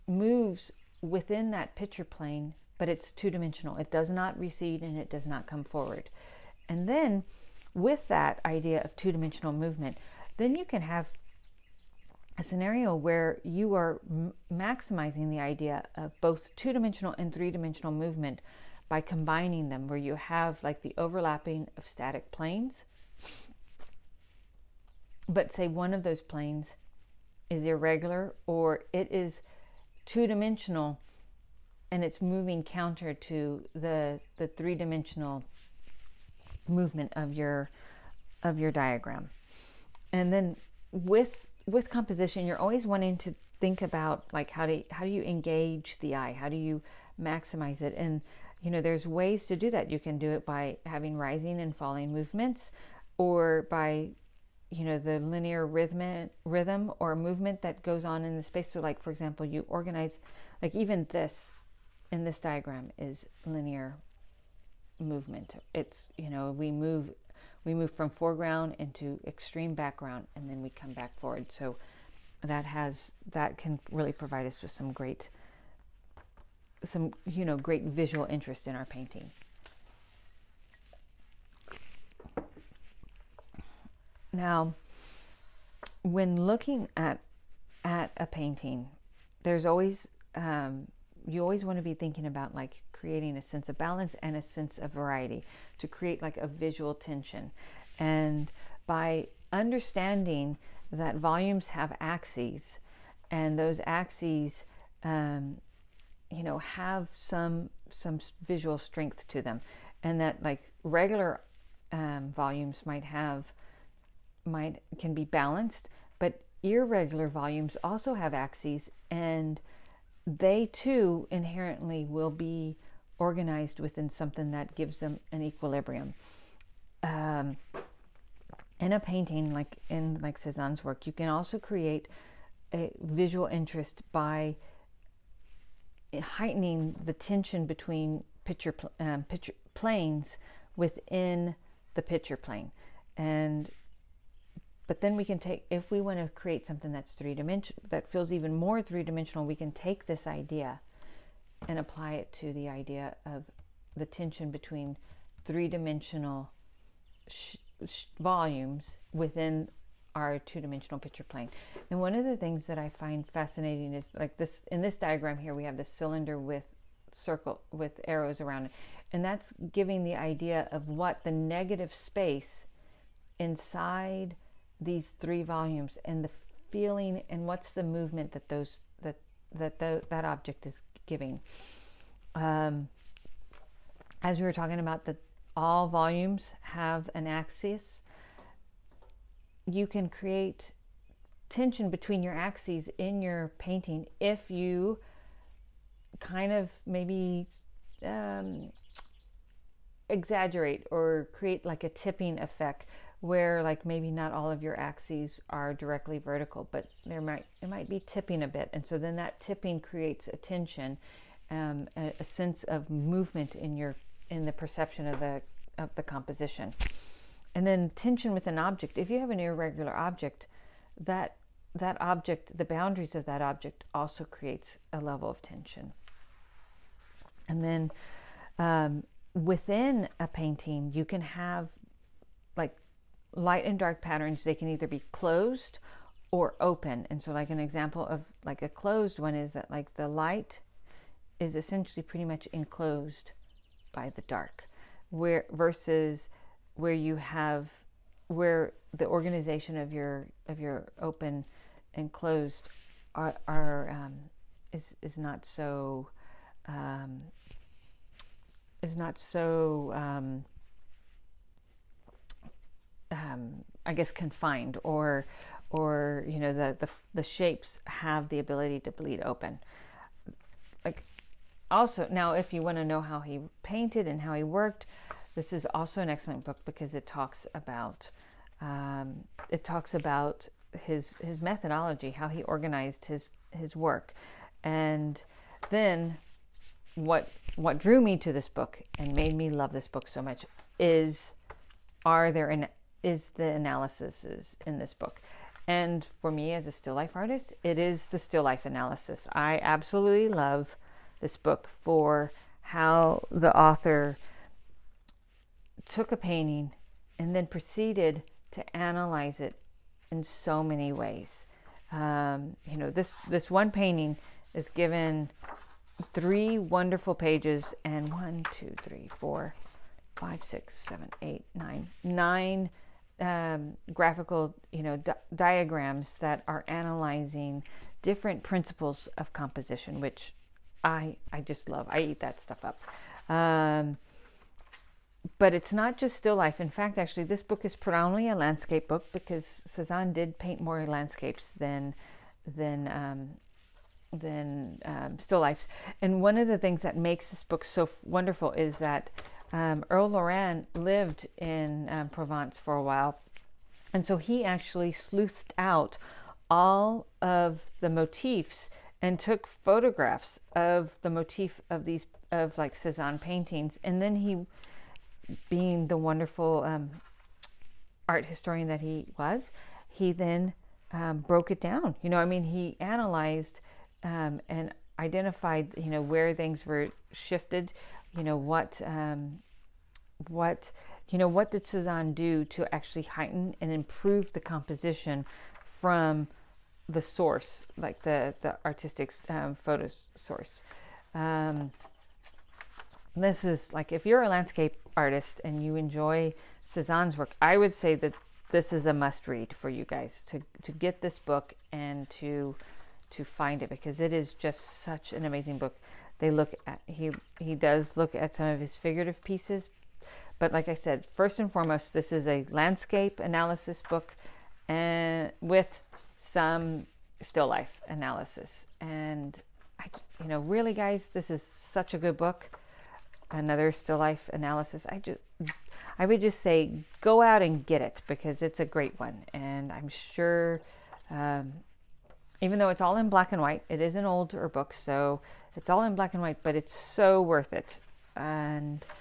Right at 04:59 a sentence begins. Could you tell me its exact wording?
I absolutely love this book for how the author took a painting and then proceeded to analyze it in so many ways.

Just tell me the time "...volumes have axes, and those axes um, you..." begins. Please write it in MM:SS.
01:41.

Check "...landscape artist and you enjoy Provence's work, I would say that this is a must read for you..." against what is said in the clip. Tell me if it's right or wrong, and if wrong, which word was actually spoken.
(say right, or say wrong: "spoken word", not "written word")
wrong: "Cezanne", not "Provence".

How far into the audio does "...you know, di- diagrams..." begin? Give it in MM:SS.
05:24.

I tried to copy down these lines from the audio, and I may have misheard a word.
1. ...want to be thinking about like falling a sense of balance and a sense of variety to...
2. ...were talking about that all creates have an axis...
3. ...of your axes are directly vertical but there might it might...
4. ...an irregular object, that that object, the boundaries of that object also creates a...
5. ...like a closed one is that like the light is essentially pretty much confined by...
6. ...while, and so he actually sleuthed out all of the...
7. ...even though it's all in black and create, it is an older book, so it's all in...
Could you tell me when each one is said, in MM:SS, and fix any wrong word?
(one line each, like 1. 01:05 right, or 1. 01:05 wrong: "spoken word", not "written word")
1. 01:31 wrong: "creating", not "falling"
2. 03:04 wrong: "volumes", not "creates"
3. 03:24 right
4. 03:39 right
5. 03:58 wrong: "enclosed", not "confined"
6. 05:52 right
7. 07:12 wrong: "white", not "create".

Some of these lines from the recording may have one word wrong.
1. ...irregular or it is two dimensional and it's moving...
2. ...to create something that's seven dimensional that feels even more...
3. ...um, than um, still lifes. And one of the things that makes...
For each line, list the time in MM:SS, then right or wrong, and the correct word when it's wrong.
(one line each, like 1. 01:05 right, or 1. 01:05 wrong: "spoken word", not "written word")
1. 00:27 right
2. 02:26 wrong: "three", not "seven"
3. 05:42 right.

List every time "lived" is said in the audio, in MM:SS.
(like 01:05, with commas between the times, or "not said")
05:50.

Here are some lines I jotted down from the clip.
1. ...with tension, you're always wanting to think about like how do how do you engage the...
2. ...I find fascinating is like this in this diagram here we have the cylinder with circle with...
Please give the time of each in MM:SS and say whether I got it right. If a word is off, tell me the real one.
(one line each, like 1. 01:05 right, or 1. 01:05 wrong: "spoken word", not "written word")
1. 00:41 wrong: "composition", not "tension"
2. 02:42 right.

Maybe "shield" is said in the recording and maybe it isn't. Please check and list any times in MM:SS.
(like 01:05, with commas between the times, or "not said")
not said.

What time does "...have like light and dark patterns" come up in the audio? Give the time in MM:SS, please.
03:51.